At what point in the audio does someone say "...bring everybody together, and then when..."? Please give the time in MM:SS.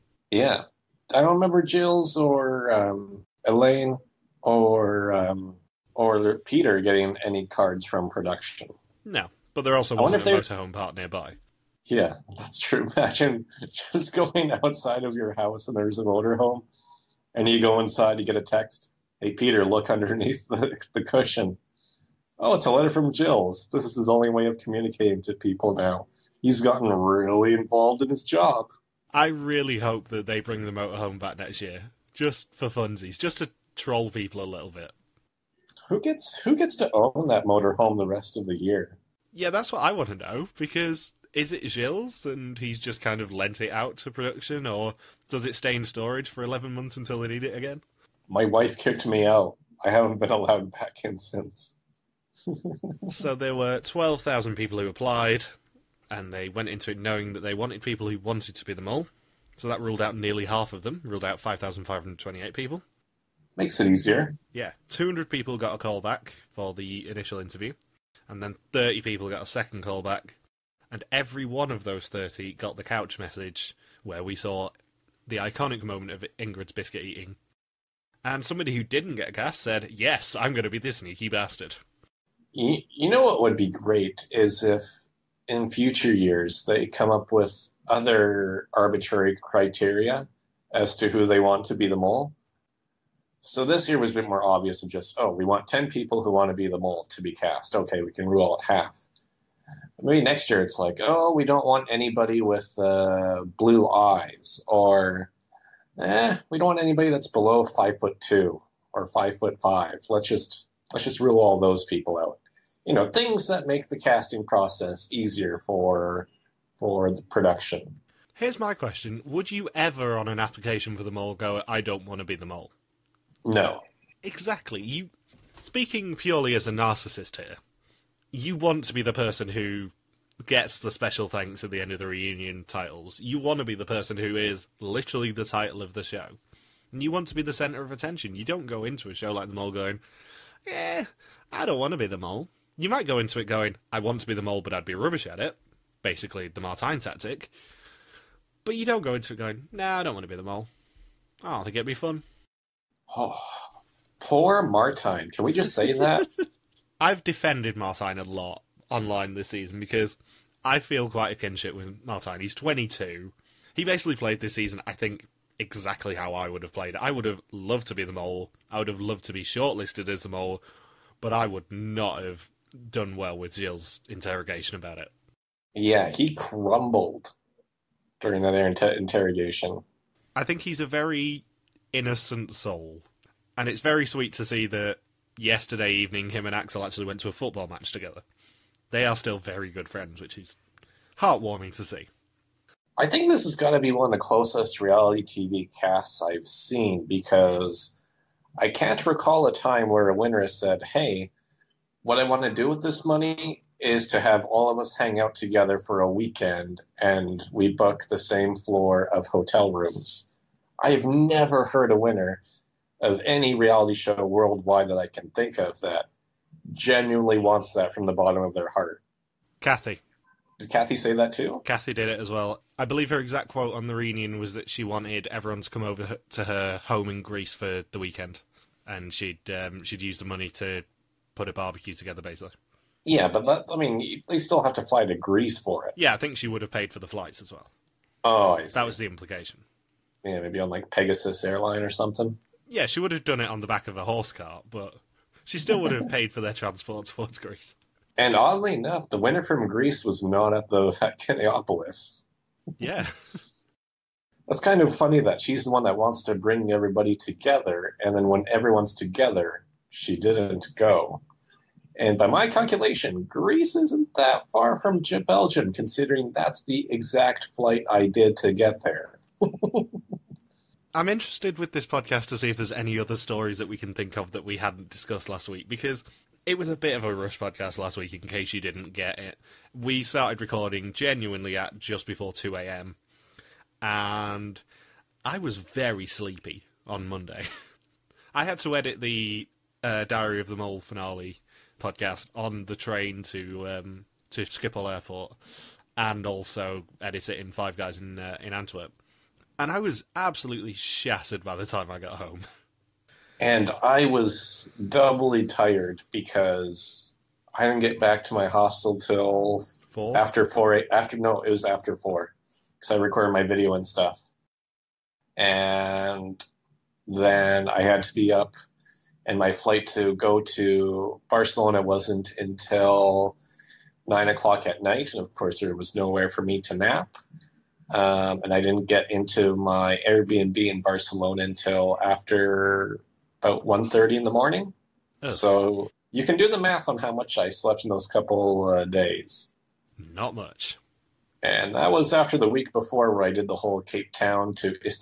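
04:16.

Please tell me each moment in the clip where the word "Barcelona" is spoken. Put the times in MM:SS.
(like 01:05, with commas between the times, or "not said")
05:21, 05:30.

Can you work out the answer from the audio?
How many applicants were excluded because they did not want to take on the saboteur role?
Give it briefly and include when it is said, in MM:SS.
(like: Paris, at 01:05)
5,528, at 01:01.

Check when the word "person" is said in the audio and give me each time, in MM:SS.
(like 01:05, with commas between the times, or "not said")
02:09, 02:13.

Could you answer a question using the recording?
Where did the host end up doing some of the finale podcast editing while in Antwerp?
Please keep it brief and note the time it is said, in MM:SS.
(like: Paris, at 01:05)
Five Guys, at 04:57.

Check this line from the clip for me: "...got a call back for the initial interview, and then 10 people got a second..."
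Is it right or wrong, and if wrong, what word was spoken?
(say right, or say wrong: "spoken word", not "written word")
wrong: "30", not "10".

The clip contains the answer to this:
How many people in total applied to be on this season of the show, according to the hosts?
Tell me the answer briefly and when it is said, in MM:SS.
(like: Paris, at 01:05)
12,000, at 00:53.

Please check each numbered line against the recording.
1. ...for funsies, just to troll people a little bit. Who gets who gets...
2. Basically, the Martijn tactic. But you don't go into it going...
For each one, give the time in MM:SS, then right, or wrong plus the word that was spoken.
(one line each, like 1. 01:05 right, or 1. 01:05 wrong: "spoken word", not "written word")
1. 00:32 right
2. 02:26 right.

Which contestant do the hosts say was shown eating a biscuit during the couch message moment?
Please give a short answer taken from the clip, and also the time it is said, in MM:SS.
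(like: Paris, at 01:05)
Ingrid, at 01:16.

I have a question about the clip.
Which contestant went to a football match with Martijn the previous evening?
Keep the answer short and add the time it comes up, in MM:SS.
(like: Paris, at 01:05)
Axel, at 03:06.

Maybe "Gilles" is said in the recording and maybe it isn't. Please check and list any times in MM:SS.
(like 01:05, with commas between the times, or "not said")
00:01, 00:23, 00:41, 02:53.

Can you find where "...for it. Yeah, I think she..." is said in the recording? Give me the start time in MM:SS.
03:55.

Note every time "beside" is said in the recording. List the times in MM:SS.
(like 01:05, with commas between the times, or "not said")
not said.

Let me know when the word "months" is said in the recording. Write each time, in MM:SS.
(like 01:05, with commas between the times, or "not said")
00:46.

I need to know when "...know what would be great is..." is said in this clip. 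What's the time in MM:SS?
01:23.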